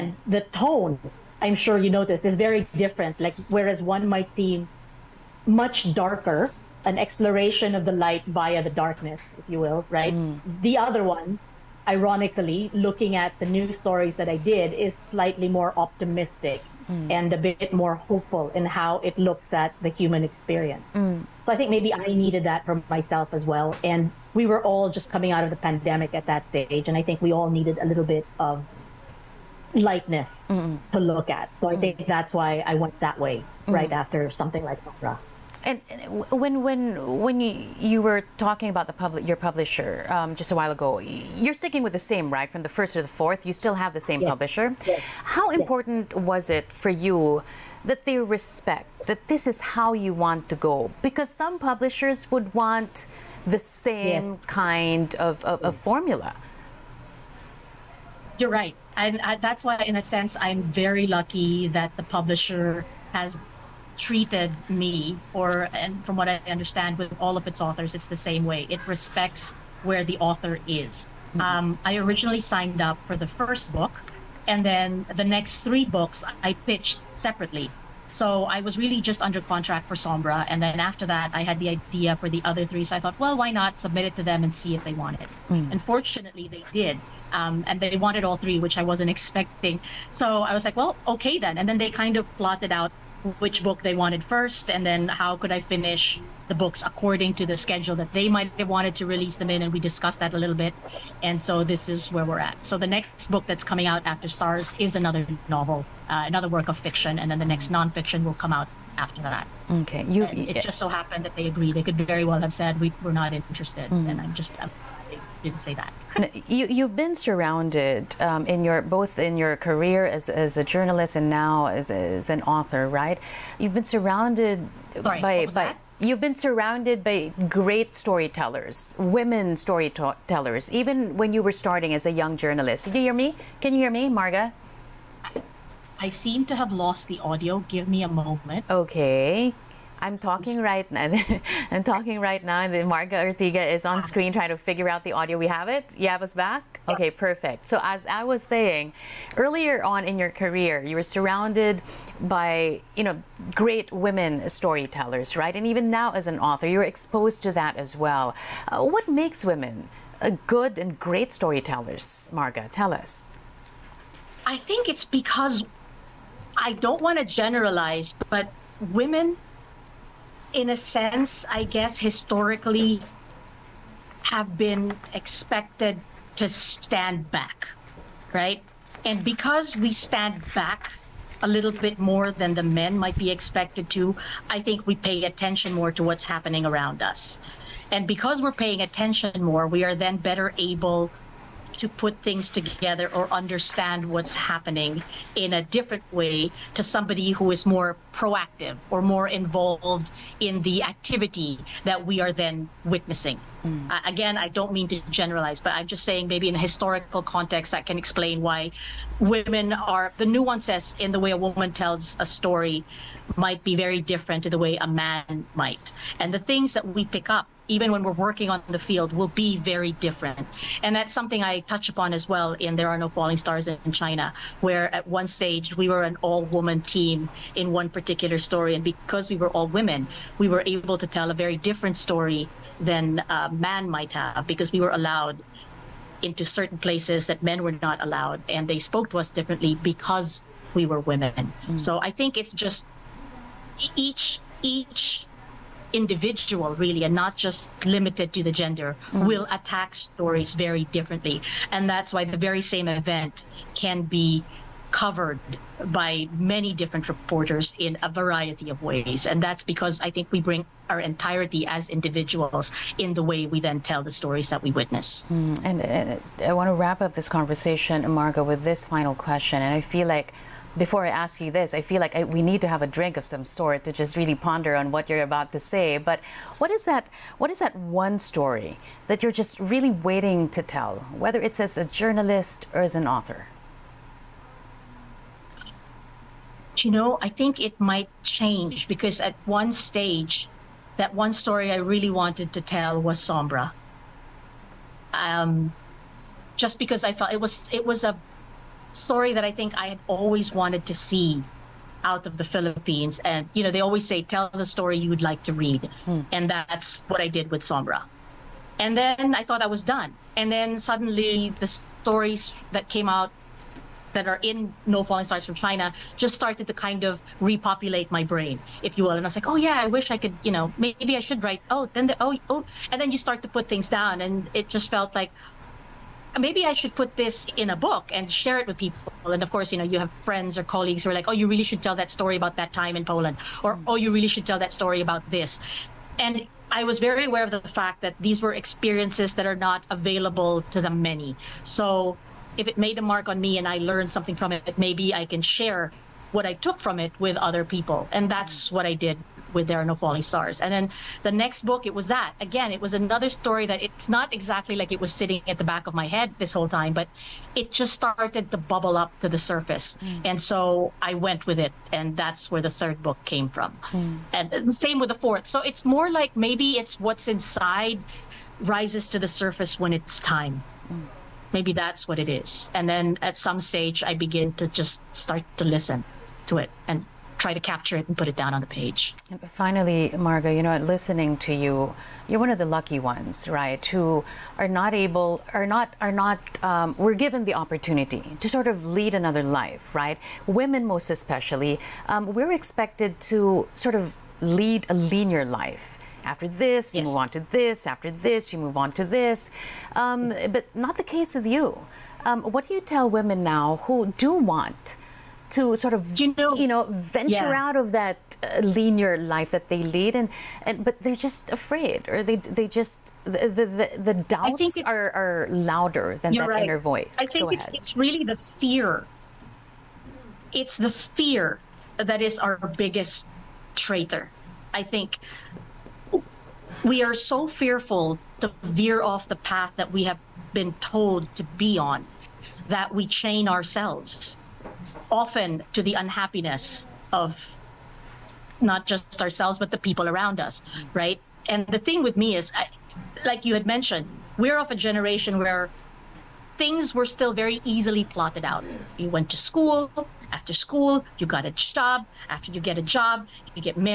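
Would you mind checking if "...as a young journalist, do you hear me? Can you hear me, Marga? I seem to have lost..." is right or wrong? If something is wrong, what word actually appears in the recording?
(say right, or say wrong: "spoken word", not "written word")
right.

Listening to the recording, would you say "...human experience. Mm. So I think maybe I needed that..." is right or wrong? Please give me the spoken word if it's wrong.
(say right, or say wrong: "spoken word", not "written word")
right.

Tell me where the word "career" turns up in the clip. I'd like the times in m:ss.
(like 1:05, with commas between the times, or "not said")
1:59, 2:30.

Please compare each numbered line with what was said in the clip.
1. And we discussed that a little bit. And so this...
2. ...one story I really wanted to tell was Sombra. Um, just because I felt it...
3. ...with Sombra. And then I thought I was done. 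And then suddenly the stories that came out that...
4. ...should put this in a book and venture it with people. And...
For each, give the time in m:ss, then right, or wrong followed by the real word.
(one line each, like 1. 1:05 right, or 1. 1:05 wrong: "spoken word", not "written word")
1. 1:39 right
2. 4:51 right
3. 5:07 right
4. 5:26 wrong: "share", not "venture".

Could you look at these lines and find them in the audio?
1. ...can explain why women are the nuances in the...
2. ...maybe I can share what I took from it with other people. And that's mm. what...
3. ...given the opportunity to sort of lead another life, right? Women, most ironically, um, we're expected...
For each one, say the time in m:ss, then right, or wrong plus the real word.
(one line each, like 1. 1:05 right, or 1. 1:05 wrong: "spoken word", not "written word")
1. 3:27 right
2. 5:44 right
3. 6:27 wrong: "especially", not "ironically".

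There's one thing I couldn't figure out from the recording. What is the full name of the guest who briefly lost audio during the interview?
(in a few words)
Marga Ortigas.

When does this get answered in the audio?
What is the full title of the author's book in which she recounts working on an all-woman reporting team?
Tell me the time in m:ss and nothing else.
3:42.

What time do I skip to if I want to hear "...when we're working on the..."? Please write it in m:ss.
3:37.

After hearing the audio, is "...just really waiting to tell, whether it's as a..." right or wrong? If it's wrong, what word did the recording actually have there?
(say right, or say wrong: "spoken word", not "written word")
right.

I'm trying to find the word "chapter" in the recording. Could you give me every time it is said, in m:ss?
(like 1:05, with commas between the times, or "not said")
not said.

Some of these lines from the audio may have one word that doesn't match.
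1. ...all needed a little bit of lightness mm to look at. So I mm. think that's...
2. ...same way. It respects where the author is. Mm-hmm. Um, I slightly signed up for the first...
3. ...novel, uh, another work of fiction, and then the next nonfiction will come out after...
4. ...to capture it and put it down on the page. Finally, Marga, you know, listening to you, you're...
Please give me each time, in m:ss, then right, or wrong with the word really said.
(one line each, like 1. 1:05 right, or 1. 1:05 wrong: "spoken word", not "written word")
1. 0:27 right
2. 1:08 wrong: "originally", not "slightly"
3. 1:45 right
4. 6:17 right.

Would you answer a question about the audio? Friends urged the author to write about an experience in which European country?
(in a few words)
Poland.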